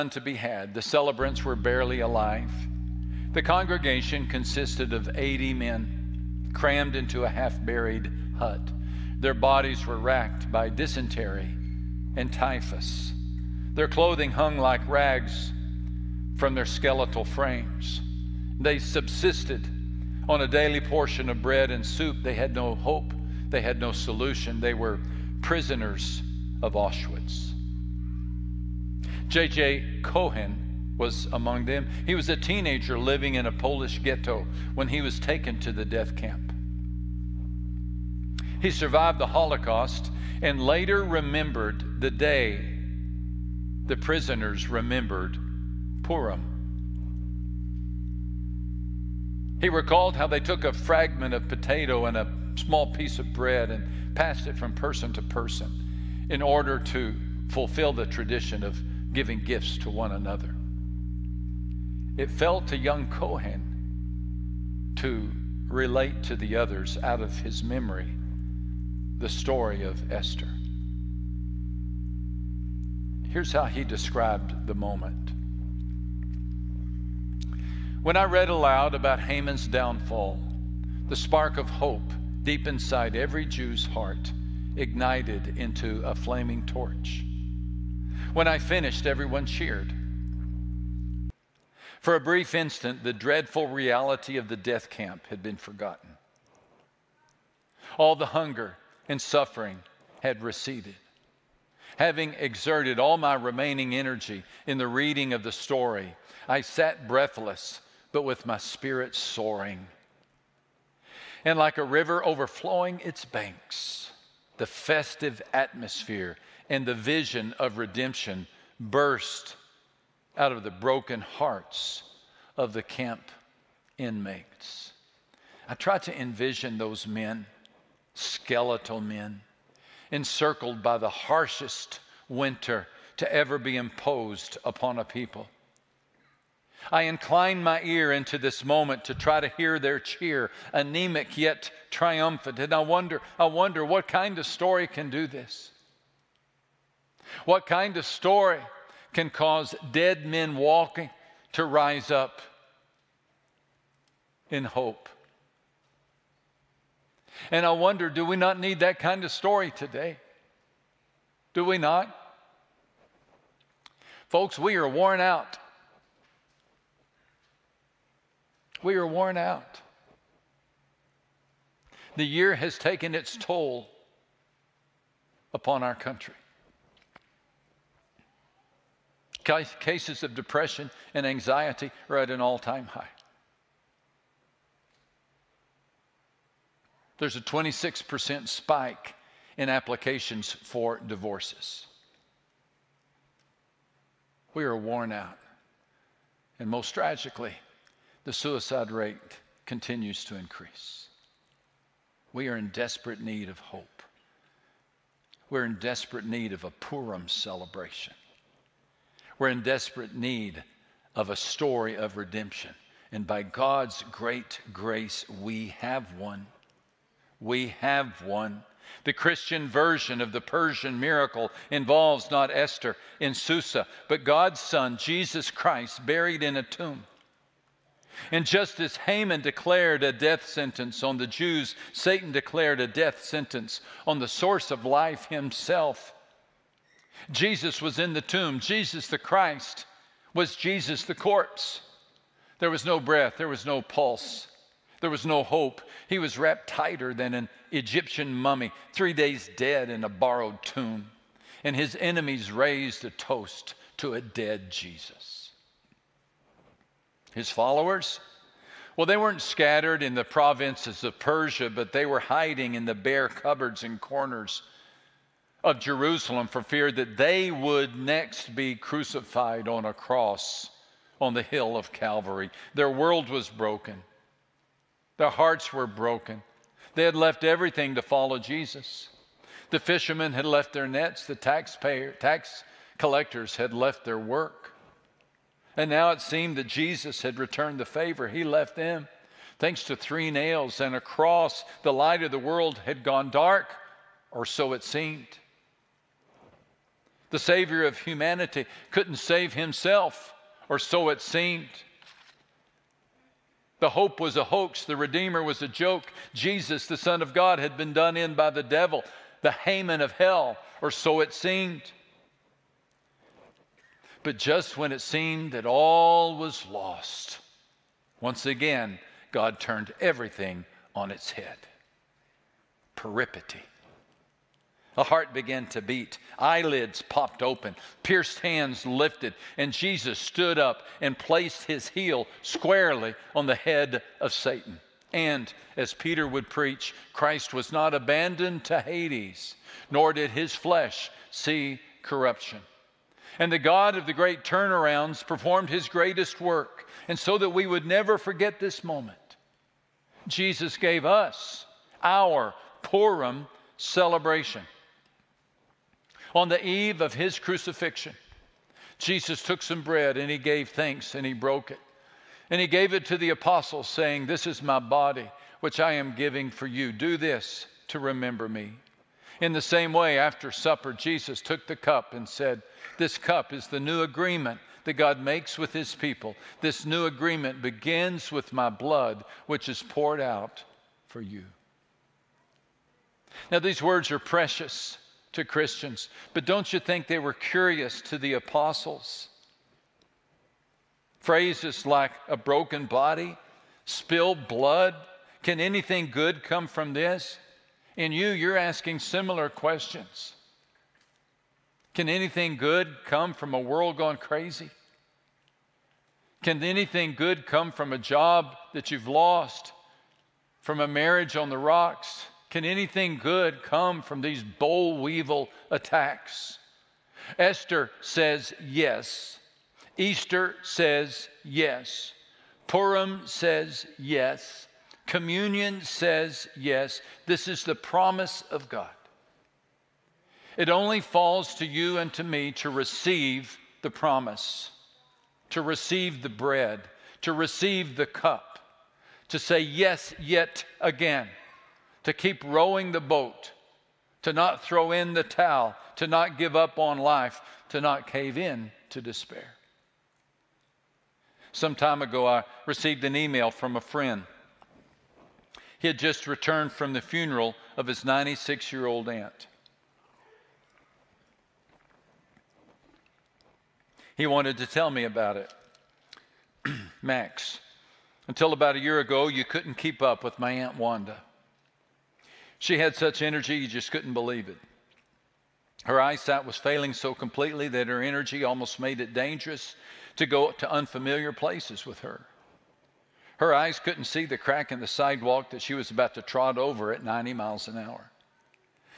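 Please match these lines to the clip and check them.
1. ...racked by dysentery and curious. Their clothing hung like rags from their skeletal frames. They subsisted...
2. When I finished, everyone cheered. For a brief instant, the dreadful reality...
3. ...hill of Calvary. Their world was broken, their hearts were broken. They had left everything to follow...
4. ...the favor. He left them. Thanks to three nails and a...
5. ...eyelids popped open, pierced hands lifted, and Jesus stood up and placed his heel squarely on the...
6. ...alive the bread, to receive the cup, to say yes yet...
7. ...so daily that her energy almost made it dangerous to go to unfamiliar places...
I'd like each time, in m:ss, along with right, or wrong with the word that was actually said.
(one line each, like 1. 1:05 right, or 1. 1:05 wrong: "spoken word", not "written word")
1. 0:09 wrong: "typhus", not "curious"
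2. 1:28 right
3. 4:31 right
4. 4:47 right
5. 5:26 right
6. 7:15 wrong: "receive", not "alive"
7. 7:56 wrong: "completely", not "daily".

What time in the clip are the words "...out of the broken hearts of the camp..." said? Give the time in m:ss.
2:00.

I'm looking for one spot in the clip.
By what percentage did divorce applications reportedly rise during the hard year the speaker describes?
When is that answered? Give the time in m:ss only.
3:07.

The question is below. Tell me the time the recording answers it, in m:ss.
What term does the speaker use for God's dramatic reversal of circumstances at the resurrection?
5:22.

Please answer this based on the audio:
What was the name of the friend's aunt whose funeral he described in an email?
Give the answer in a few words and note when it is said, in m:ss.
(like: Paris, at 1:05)
Wanda, at 7:50.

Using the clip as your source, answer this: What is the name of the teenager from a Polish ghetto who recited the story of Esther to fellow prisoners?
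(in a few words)
J.J. Cohen.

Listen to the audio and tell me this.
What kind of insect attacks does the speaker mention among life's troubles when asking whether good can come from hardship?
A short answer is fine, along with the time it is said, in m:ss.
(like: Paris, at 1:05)
Boll weevil, at 6:54.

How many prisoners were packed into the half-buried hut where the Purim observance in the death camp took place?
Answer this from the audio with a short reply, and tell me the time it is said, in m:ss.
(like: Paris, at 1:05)
80, at 0:05.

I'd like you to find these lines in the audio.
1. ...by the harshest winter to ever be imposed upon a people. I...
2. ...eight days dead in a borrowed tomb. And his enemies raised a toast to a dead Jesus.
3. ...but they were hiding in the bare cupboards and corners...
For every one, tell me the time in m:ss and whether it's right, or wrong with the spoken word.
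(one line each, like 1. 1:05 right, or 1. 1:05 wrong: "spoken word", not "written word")
1. 2:10 right
2. 4:08 wrong: "three", not "eight"
3. 4:21 right.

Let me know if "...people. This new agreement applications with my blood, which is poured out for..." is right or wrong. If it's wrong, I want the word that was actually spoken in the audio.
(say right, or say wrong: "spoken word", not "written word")
wrong: "begins", not "applications".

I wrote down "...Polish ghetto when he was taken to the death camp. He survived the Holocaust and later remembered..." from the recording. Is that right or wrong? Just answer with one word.
right.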